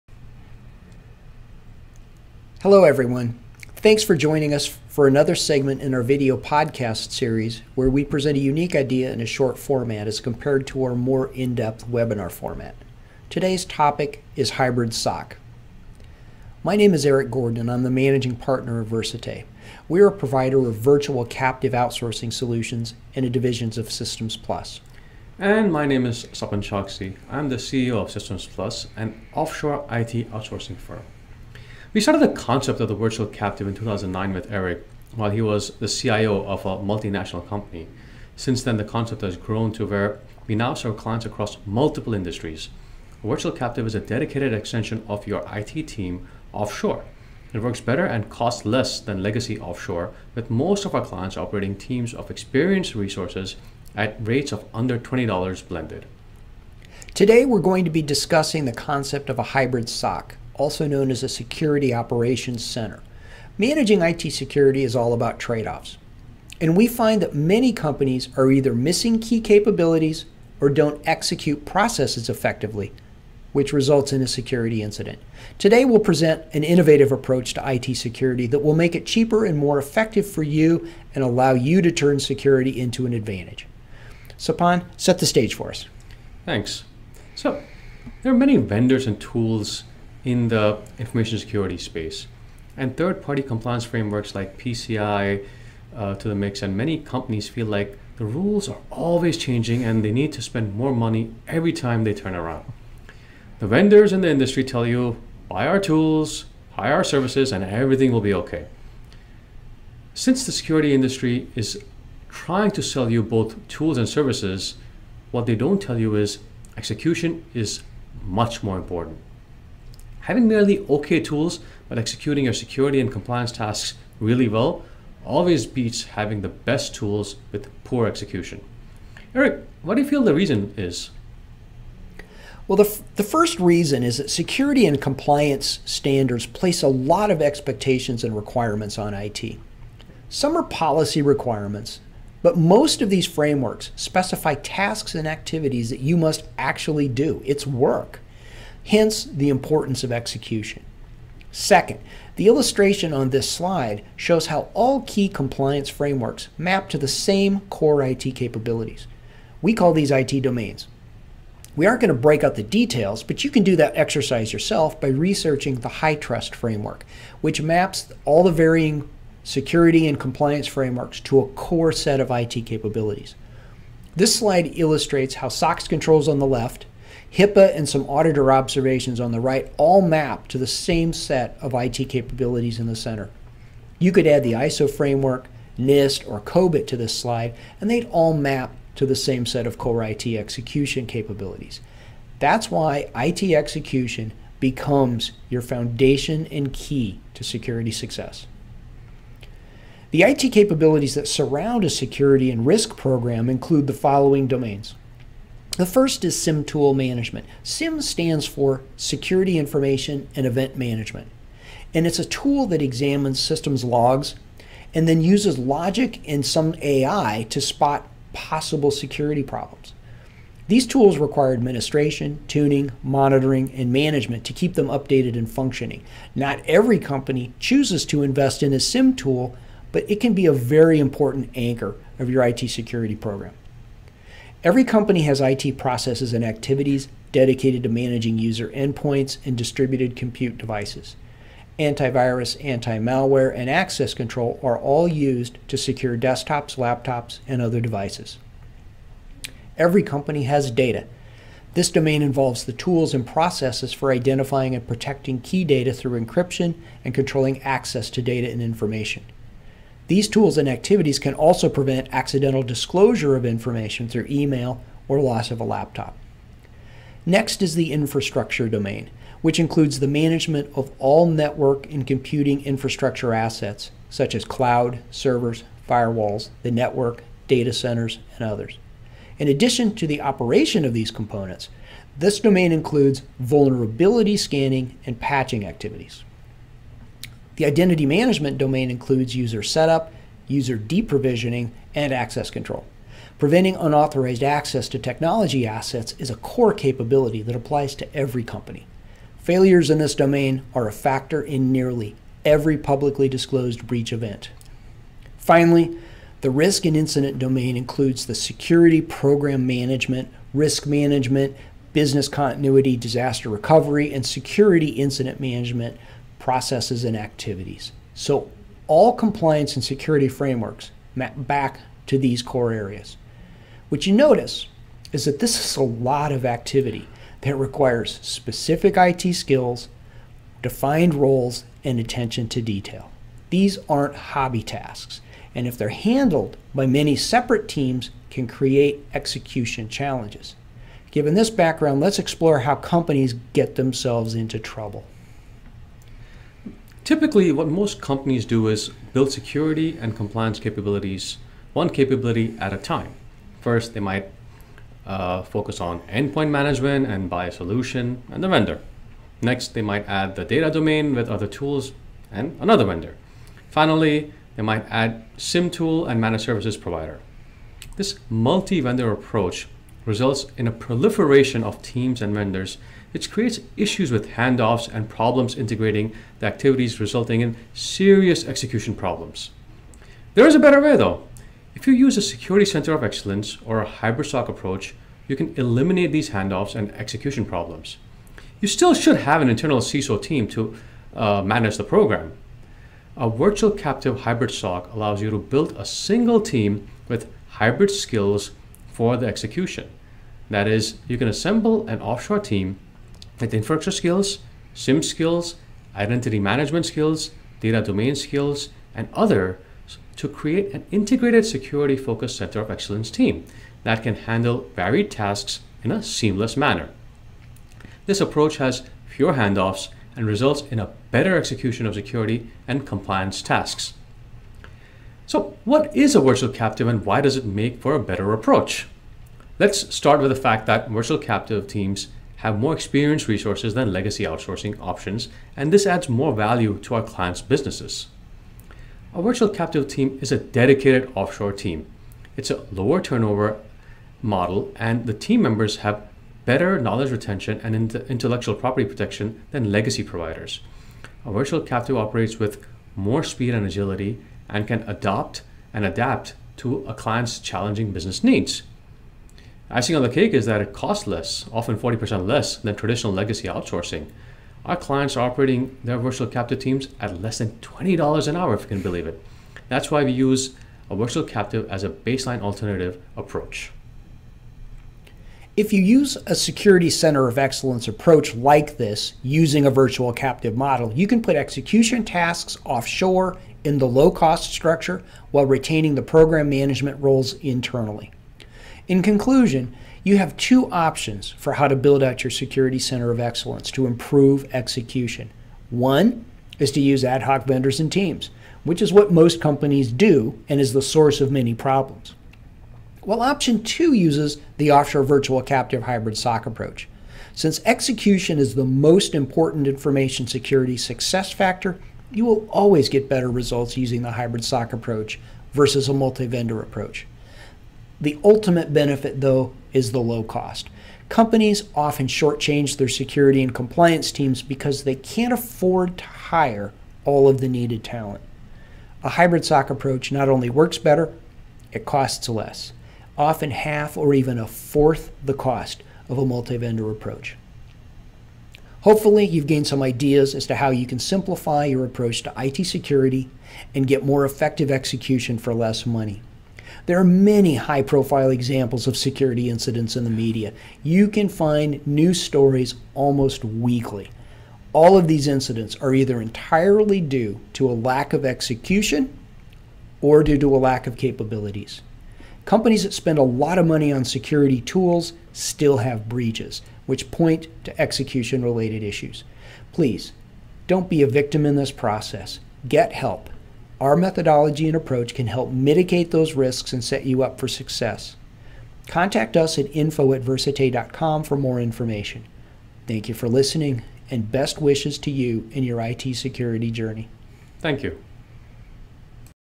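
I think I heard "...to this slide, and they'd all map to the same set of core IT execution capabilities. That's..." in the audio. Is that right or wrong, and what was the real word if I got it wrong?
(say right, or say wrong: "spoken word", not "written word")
right.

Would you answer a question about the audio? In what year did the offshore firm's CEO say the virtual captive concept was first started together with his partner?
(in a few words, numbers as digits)
2009.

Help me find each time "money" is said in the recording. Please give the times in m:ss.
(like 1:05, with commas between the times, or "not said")
1:40, 9:05, 9:23.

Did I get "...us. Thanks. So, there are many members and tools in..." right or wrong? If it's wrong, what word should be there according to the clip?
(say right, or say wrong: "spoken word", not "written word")
wrong: "vendors", not "members".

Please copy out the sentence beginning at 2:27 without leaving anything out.
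It's work hence the importance of execution.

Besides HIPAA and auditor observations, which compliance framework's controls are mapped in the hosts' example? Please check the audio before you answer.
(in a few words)
SOX.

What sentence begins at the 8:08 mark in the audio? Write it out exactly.
In conclusion, you have two options for how to build out your security center of excellence to improve execution.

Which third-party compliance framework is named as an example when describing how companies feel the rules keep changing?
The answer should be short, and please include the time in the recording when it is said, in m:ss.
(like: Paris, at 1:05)
PCI, at 1:34.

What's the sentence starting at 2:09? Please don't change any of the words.
Eric, what do you feel the reason is?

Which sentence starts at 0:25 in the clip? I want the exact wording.
And my name is Sapan Choksi.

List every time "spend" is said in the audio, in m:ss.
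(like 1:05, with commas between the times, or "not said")
1:40, 9:22.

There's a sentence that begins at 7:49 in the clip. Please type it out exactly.
That's why we use a virtual captive as a baseline alternative approach.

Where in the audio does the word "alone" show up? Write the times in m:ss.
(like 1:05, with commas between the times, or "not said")
not said.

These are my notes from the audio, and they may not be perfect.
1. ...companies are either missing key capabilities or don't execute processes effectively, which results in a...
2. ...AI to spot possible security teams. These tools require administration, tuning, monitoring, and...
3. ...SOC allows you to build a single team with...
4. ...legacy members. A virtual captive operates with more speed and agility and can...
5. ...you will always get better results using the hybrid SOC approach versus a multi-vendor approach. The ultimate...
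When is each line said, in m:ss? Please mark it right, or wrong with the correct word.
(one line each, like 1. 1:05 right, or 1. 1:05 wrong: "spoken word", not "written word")
1. 1:07 right
2. 3:36 wrong: "problems", not "teams"
3. 6:34 right
4. 7:29 wrong: "providers", not "members"
5. 8:32 right.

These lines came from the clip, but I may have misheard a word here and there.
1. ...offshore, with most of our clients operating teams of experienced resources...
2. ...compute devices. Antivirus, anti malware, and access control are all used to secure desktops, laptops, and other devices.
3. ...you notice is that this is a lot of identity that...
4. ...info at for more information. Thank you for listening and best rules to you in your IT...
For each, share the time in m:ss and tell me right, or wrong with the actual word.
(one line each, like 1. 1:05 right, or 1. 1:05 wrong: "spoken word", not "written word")
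1. 0:49 right
2. 4:00 right
3. 5:24 wrong: "activity", not "identity"
4. 9:39 wrong: "wishes", not "rules".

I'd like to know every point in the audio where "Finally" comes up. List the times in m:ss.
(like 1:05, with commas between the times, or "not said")
5:05, 6:03.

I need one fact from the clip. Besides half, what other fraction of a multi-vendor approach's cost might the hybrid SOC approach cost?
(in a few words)
a fourth.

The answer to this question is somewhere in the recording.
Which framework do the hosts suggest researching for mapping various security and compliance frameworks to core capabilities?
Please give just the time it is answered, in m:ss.
2:45.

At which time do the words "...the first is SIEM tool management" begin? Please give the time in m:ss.
3:25.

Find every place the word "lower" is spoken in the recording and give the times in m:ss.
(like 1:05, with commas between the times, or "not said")
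7:22.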